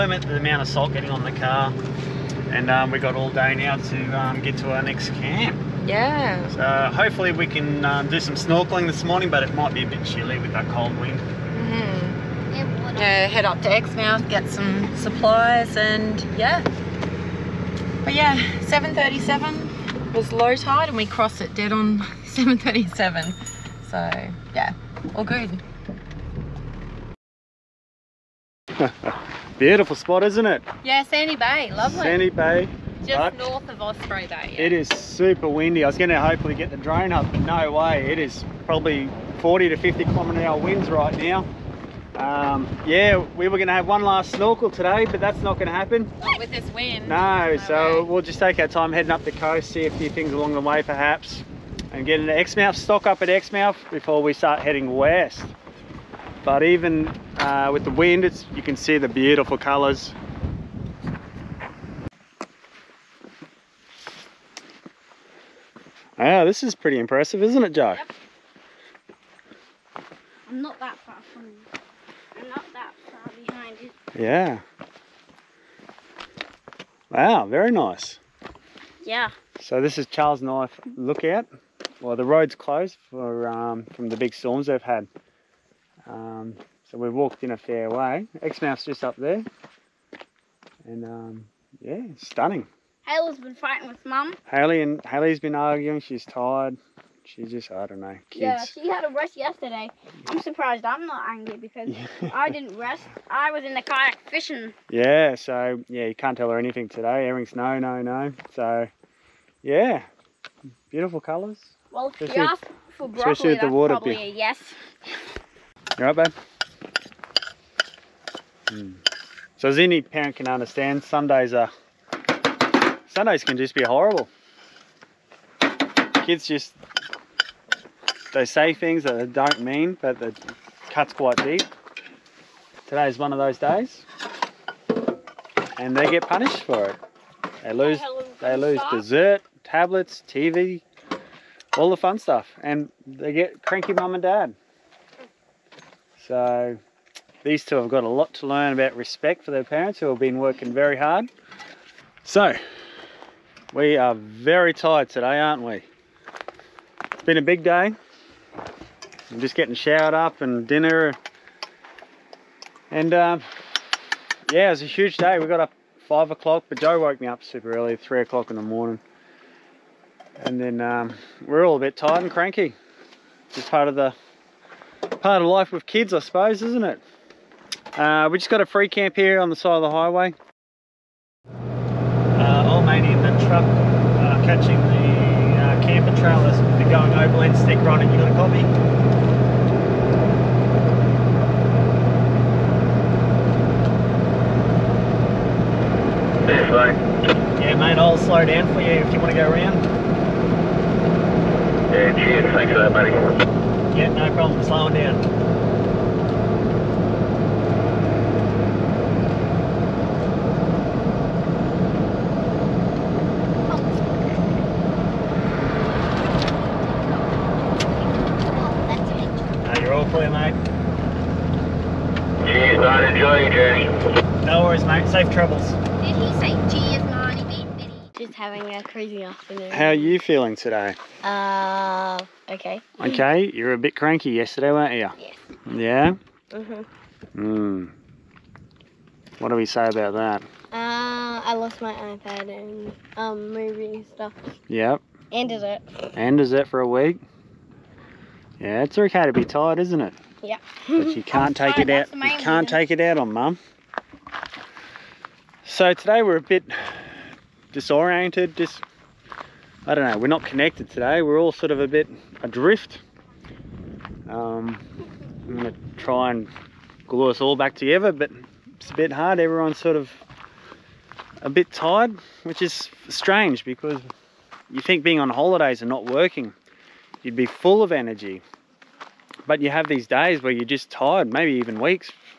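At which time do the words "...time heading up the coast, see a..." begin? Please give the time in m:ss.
0:48.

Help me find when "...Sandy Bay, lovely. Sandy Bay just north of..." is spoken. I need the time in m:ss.
0:31.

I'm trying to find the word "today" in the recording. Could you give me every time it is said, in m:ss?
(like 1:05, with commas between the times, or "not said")
0:44, 1:46, 2:12, 2:35, 3:50, 4:15, 4:20.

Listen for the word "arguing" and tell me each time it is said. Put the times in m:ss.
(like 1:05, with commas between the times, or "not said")
1:35.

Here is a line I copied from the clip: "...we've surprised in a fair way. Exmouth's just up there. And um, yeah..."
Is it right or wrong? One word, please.
wrong.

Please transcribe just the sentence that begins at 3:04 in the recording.
catching the uh, camper trailers if you are going overland, stick running.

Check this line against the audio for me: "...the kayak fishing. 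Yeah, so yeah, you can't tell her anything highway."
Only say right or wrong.
wrong.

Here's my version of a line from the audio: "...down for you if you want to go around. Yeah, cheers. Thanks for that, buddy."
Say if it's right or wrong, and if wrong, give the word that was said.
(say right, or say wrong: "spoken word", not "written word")
right.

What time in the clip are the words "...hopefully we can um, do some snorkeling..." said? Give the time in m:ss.
0:06.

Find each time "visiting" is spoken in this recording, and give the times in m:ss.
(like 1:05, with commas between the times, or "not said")
not said.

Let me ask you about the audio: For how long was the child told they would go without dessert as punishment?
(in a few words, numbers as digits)
A week.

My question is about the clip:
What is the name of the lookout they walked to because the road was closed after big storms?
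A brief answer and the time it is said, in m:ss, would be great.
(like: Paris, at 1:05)
Charles Knife Lookout, at 1:20.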